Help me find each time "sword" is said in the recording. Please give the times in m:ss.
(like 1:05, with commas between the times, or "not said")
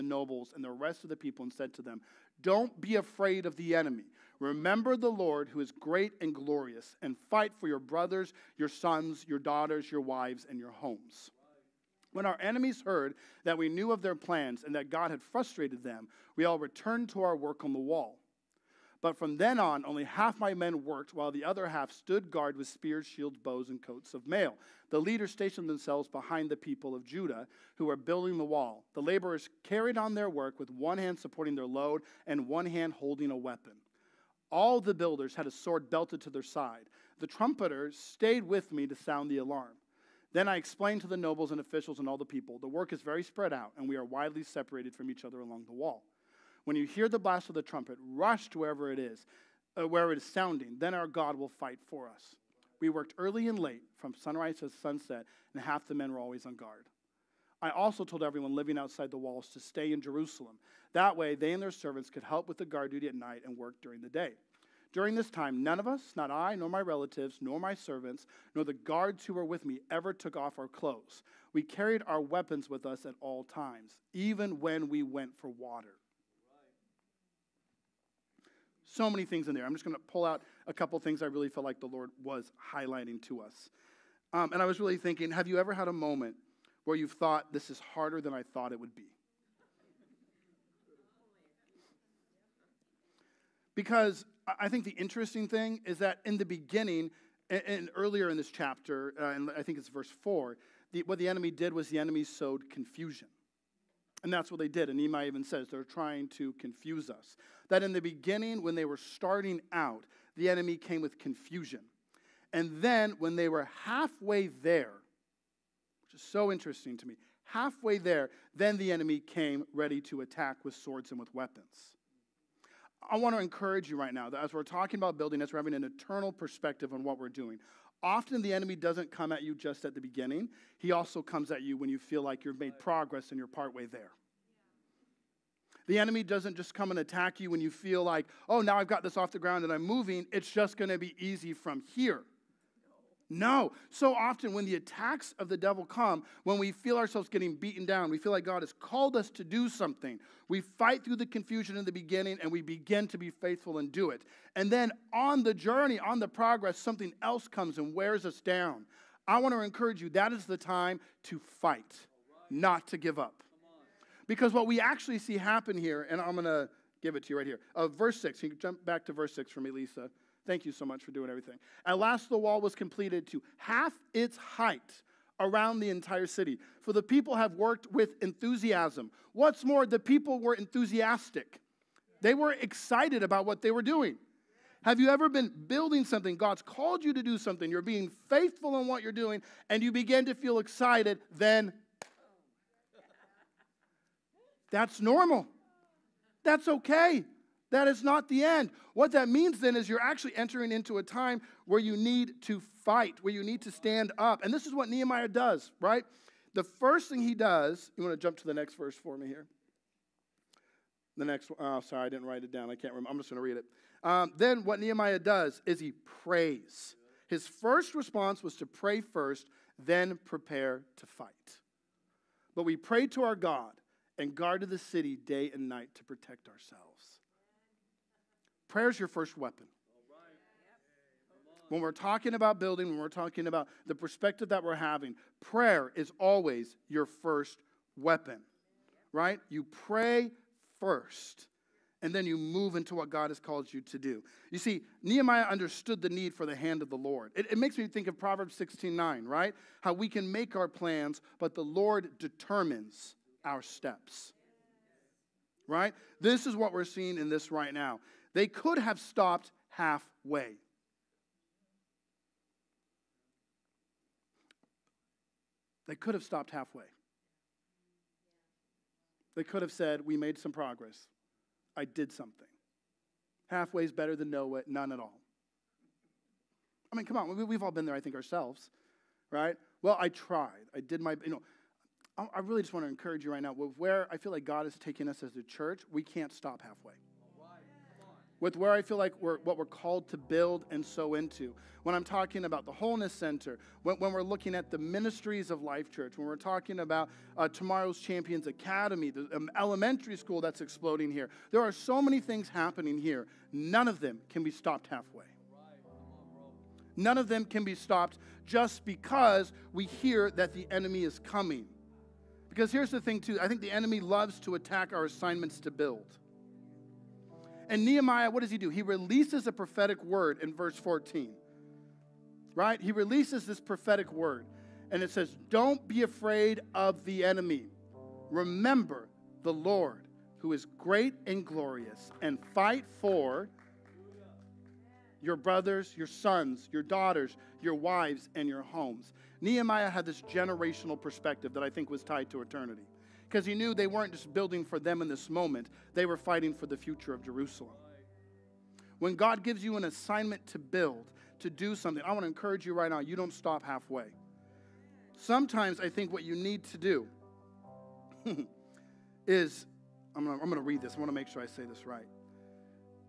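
0:35, 2:00.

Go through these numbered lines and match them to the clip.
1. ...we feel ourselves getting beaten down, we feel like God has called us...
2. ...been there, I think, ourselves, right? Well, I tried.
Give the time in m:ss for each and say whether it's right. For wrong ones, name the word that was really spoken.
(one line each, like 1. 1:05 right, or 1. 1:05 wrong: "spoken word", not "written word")
1. 2:26 right
2. 4:37 right.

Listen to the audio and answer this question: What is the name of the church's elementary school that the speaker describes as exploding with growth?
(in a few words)
Tomorrow's Champions Academy.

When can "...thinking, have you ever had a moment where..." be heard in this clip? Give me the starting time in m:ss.
1:24.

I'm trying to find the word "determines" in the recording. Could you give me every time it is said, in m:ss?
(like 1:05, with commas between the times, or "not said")
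4:12.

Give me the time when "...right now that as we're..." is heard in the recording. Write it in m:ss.
2:03.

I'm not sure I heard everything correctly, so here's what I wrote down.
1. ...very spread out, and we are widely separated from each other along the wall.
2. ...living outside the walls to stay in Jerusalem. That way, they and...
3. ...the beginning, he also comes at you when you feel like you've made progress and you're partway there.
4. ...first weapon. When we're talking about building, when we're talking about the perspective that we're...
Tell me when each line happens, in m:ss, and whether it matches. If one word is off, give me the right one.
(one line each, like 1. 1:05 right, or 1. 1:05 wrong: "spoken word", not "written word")
1. 0:43 right
2. 0:58 right
3. 2:09 right
4. 3:49 right.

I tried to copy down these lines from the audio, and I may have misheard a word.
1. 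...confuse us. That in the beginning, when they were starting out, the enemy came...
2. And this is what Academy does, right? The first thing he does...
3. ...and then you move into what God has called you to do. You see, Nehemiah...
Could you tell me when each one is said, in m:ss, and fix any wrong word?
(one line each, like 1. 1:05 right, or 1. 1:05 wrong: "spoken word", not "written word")
1. 1:46 right
2. 3:24 wrong: "Nehemiah", not "Academy"
3. 4:02 right.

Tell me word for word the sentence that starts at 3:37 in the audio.
His first response was to pray first, then prepare to fight.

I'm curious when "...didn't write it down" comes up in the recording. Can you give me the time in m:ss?
3:32.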